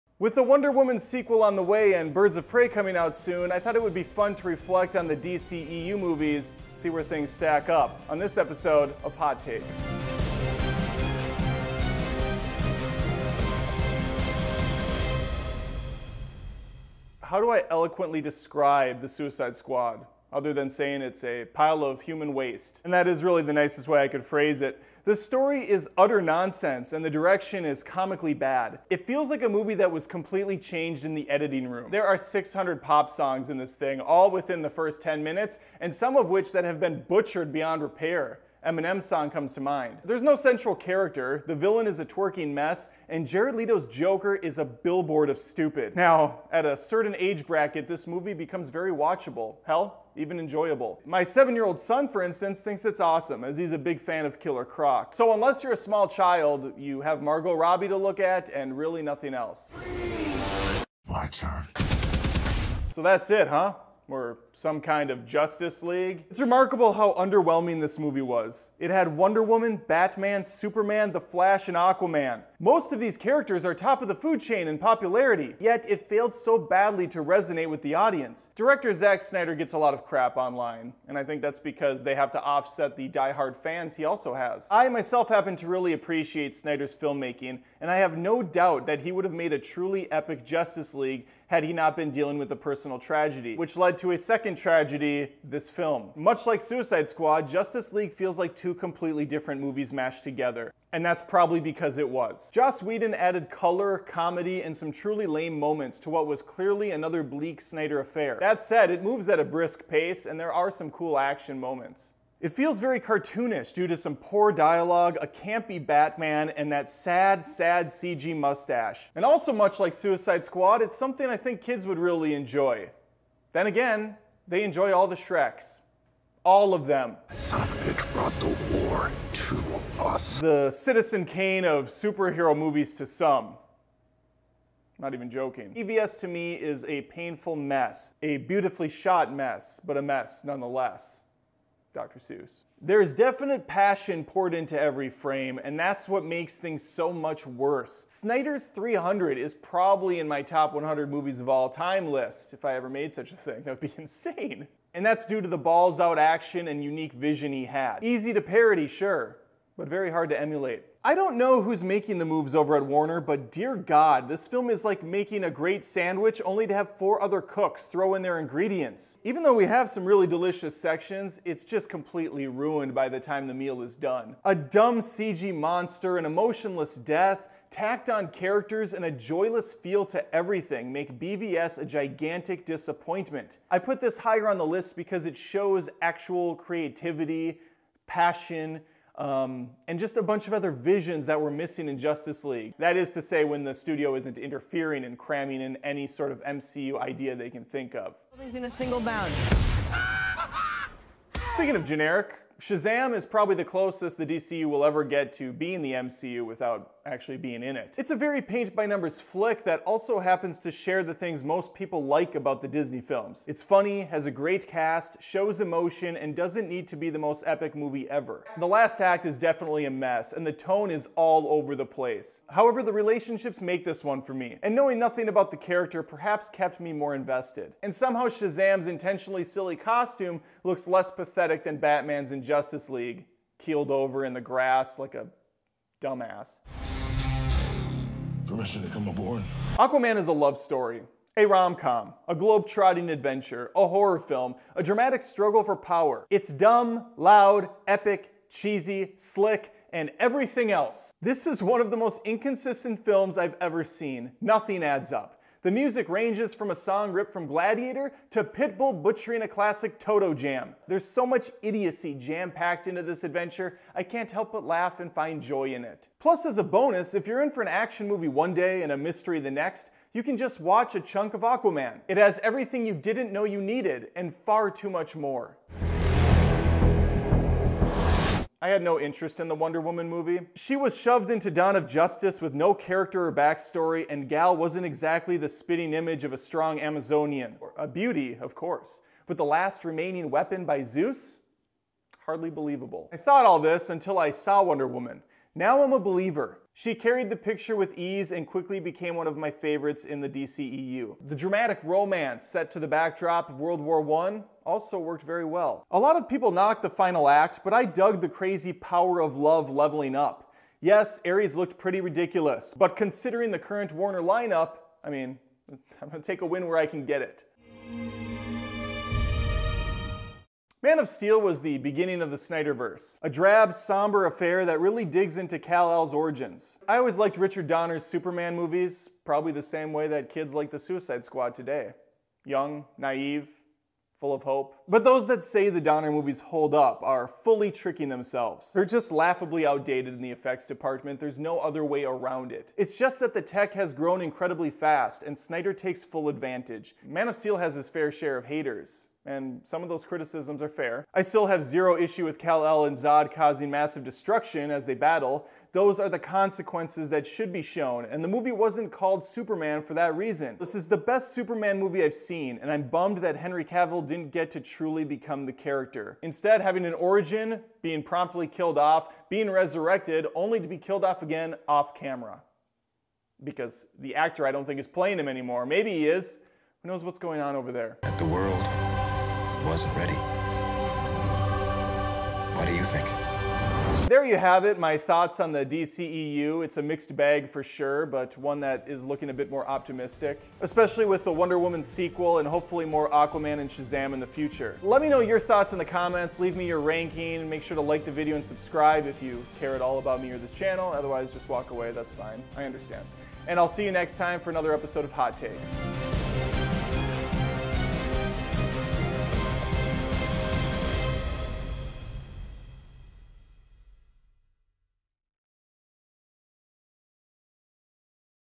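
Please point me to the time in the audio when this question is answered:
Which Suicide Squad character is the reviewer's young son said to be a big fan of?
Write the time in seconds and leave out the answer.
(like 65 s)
54 s.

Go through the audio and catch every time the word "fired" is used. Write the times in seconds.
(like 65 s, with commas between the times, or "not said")
not said.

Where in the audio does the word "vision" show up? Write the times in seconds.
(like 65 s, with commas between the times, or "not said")
157 s, 190 s.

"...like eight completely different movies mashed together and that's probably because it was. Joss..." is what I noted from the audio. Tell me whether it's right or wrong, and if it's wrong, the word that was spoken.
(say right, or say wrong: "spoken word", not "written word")
wrong: "two", not "eight".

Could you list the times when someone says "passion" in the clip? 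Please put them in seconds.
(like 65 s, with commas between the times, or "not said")
143 s, 188 s.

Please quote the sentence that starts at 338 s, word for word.
They're just laughably outdated in the effects department, there's no other way around it.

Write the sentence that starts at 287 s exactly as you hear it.
A beauty, of course, but the last remaining weapon by Zeus?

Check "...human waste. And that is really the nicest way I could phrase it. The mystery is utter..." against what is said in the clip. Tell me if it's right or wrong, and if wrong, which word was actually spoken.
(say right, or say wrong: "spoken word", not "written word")
wrong: "story", not "mystery".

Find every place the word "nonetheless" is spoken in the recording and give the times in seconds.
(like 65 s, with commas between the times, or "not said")
140 s.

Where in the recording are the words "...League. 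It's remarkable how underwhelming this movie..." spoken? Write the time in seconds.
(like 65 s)
65 s.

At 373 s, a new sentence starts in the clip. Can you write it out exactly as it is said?
Because the actor I don't think is playing him anymore.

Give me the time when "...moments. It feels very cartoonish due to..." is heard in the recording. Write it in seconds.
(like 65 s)
111 s.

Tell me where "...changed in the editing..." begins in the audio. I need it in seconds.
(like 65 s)
30 s.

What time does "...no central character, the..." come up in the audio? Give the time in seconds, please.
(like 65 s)
40 s.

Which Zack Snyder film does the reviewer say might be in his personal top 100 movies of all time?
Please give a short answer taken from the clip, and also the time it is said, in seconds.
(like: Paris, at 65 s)
300, at 148 s.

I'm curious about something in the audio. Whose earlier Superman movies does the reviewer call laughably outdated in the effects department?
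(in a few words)
Richard Donner.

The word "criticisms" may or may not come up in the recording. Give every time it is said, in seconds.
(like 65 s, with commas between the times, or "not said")
350 s.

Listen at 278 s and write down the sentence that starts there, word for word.
I had no interest in the Wonder Woman movie.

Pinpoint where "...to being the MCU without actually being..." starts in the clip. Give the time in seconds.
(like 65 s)
205 s.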